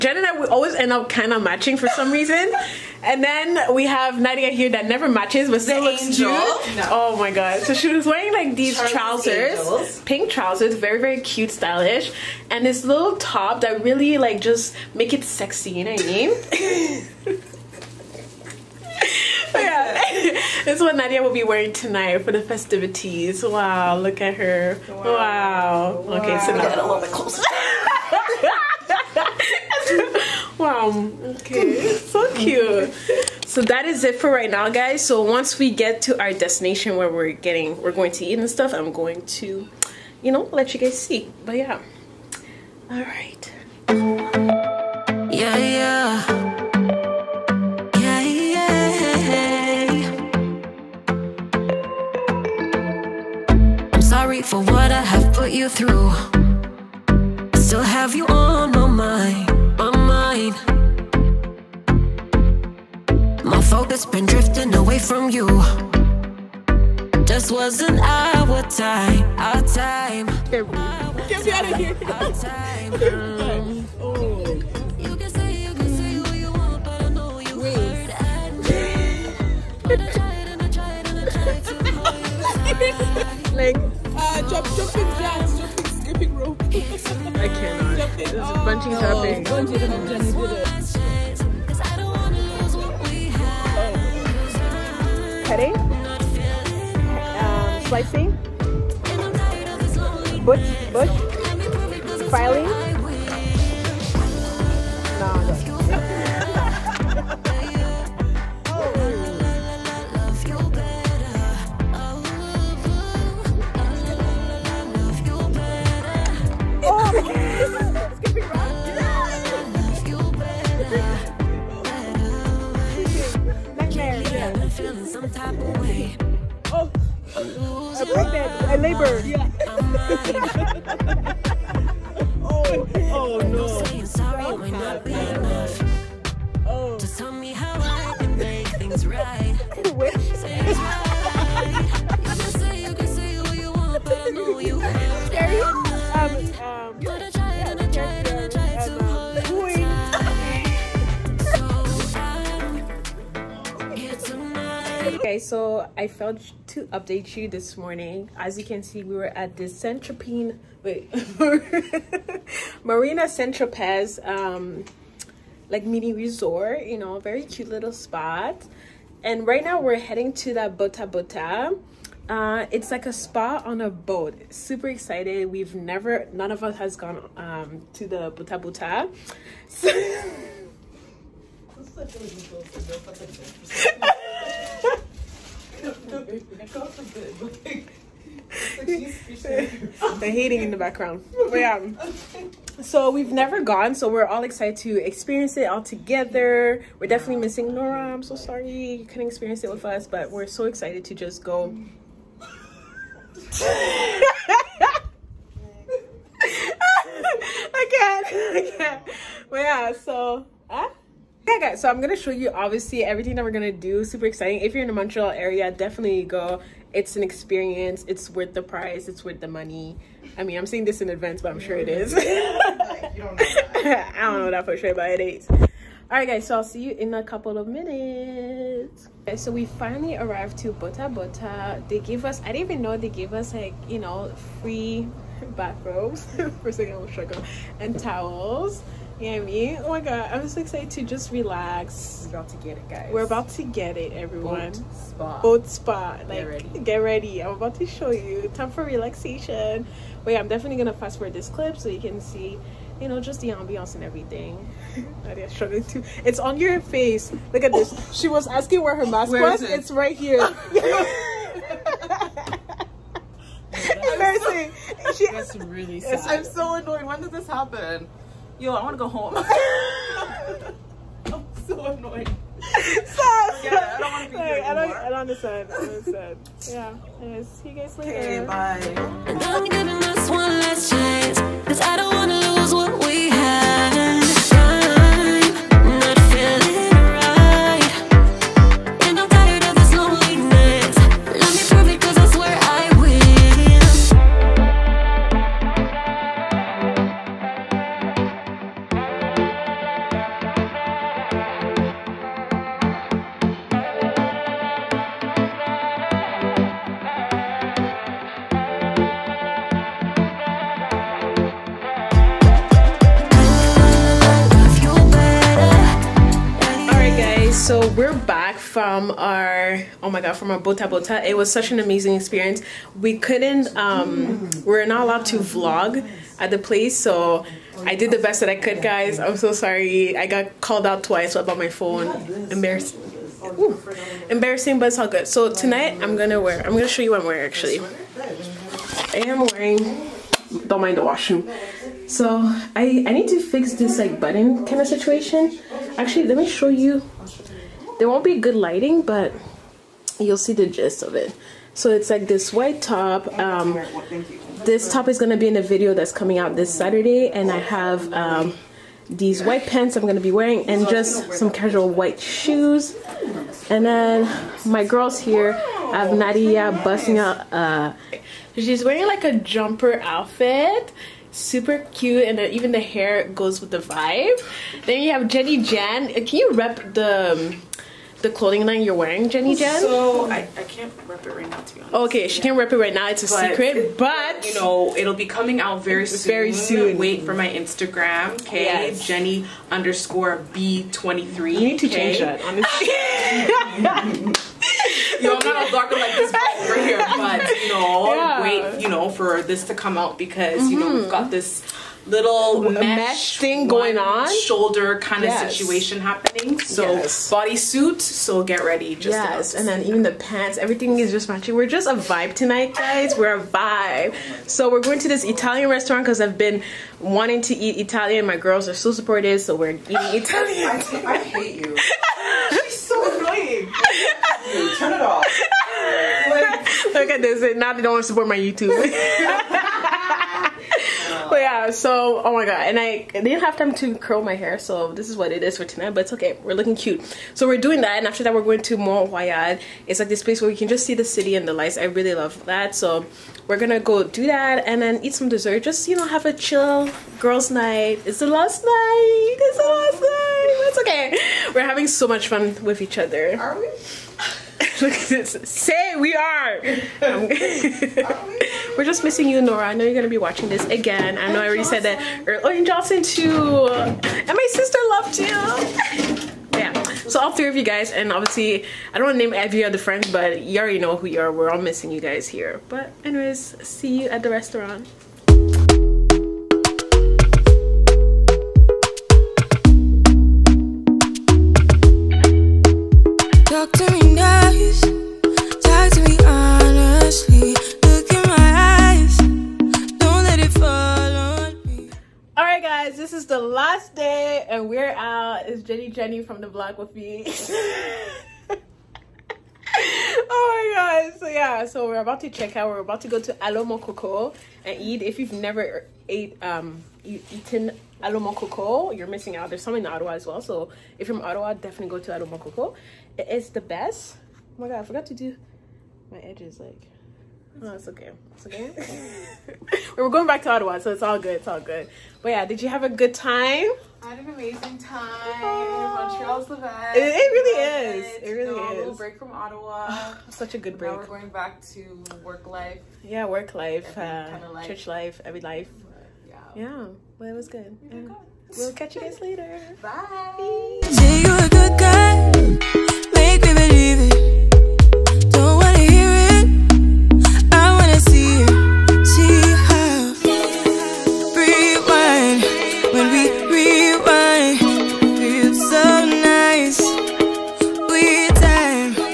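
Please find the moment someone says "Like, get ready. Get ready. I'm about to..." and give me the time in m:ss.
4:06.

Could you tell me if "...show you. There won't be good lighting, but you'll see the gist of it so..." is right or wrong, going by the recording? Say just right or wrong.
right.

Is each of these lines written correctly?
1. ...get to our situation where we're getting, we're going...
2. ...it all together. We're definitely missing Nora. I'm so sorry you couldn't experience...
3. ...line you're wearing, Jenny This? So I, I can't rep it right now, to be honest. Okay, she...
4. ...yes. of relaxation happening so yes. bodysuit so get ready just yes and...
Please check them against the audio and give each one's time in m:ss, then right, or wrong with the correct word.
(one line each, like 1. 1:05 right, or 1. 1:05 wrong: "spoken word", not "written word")
1. 0:35 wrong: "destination", not "situation"
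2. 3:15 right
3. 6:18 wrong: "Jen", not "This"
4. 6:45 wrong: "situation", not "relaxation".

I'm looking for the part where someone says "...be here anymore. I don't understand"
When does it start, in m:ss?
4:34.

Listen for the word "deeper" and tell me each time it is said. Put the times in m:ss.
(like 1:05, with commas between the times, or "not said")
not said.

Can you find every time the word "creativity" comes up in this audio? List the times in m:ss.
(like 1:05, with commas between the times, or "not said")
not said.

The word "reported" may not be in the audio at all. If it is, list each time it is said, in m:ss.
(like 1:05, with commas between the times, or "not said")
not said.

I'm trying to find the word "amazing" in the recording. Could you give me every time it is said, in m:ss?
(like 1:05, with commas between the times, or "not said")
5:21, 8:44.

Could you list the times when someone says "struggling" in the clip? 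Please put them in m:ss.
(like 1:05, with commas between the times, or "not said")
3:57, 4:15.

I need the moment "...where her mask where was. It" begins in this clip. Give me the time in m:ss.
4:18.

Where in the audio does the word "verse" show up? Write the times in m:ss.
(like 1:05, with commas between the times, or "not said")
not said.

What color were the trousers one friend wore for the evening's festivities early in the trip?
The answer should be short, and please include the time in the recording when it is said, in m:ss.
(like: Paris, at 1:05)
Pink, at 0:10.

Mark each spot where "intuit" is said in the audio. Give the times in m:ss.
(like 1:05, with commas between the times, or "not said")
not said.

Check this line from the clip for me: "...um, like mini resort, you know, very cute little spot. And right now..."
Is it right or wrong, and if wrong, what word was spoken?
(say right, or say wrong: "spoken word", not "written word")
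right.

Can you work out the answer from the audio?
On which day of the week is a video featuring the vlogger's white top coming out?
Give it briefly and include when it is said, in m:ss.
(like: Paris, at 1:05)
Saturday, at 5:56.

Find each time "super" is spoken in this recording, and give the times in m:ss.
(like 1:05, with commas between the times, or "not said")
2:54, 3:34, 6:11.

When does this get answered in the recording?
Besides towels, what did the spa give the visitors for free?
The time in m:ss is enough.
3:55.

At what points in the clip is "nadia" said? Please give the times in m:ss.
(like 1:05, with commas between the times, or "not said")
0:04, 0:20, 4:15, 6:06.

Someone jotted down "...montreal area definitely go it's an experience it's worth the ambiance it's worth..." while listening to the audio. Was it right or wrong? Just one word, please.
wrong.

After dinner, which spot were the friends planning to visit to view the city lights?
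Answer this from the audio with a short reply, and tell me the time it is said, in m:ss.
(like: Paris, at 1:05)
Mont Royal, at 7:18.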